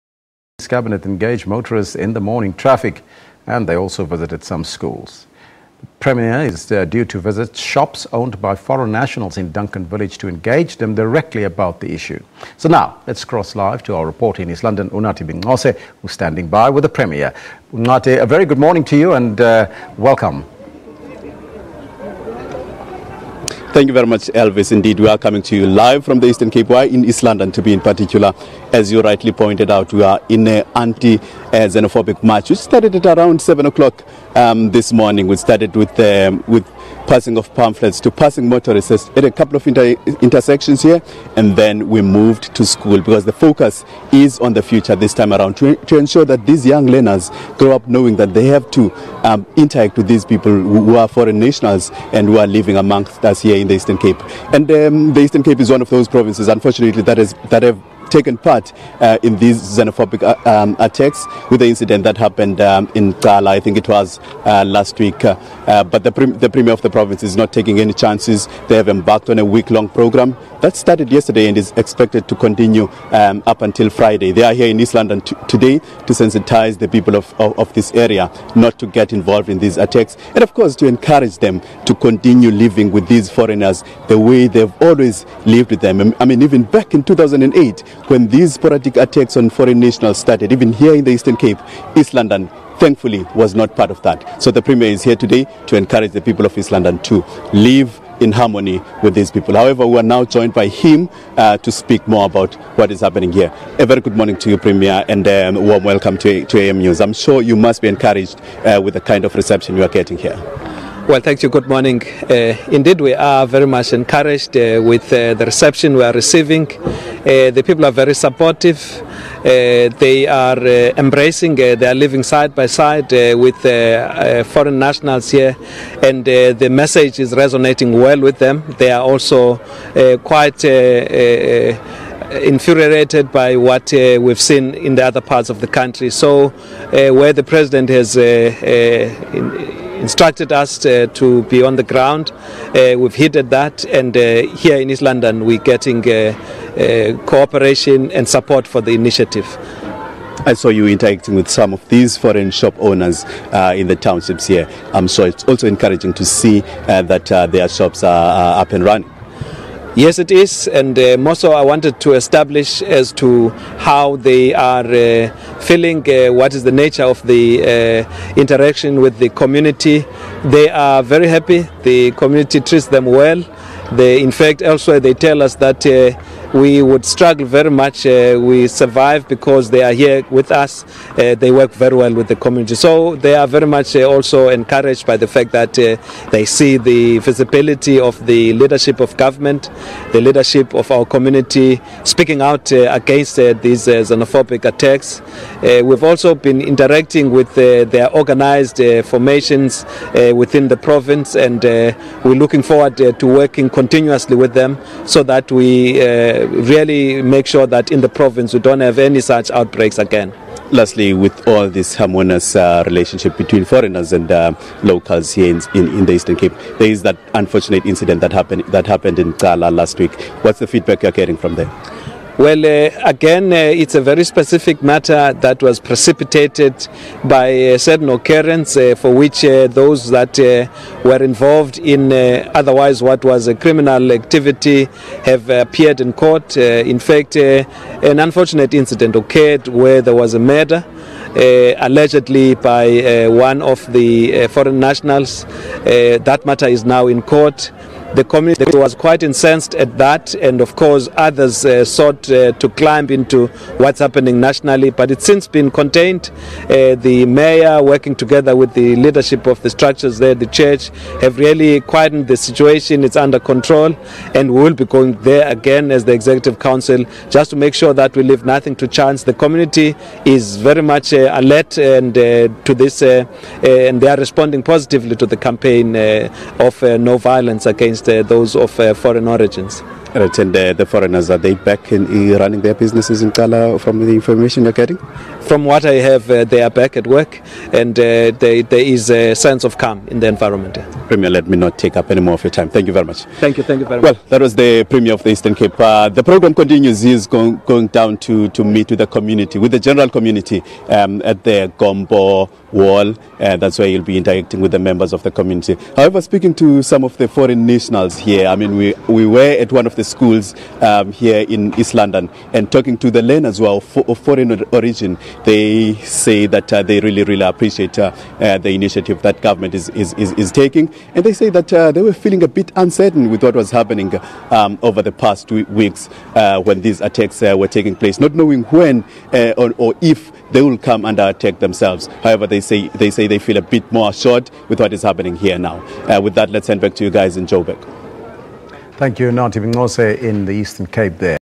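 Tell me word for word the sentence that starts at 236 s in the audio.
in fact, an unfortunate incident occurred where there was a murder.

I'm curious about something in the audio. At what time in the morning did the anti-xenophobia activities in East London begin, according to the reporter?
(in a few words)
7 o'clock.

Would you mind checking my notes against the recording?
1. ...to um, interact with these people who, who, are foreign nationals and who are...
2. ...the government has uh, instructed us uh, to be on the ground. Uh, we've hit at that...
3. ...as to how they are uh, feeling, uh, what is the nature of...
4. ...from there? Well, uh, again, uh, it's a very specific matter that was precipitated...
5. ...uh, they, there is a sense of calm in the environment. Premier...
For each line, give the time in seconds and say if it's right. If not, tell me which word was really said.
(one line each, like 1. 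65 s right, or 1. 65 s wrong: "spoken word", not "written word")
1. 48 s right
2. 137 s wrong: "president", not "government"
3. 162 s right
4. 221 s right
5. 287 s right.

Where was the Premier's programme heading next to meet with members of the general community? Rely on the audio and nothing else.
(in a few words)
Gompo wall.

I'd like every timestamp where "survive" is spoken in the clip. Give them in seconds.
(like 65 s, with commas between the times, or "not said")
178 s.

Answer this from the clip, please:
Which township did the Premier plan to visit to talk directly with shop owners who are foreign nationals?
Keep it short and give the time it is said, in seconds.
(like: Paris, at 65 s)
Duncan Village, at 9 s.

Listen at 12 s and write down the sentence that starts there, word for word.
So now, let's cross live to our reporter in East London, Unathi Binqose, who's standing by with the Premier.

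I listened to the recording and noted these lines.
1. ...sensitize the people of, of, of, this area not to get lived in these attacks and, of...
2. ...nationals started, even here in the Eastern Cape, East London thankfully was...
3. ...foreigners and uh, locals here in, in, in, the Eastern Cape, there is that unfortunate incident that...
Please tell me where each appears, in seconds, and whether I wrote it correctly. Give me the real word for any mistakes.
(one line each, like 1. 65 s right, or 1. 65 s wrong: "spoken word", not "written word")
1. 76 s wrong: "involved", not "lived"
2. 89 s right
3. 213 s right.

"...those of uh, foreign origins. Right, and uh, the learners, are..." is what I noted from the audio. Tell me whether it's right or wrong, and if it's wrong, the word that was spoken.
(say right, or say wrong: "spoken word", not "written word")
wrong: "foreigners", not "learners".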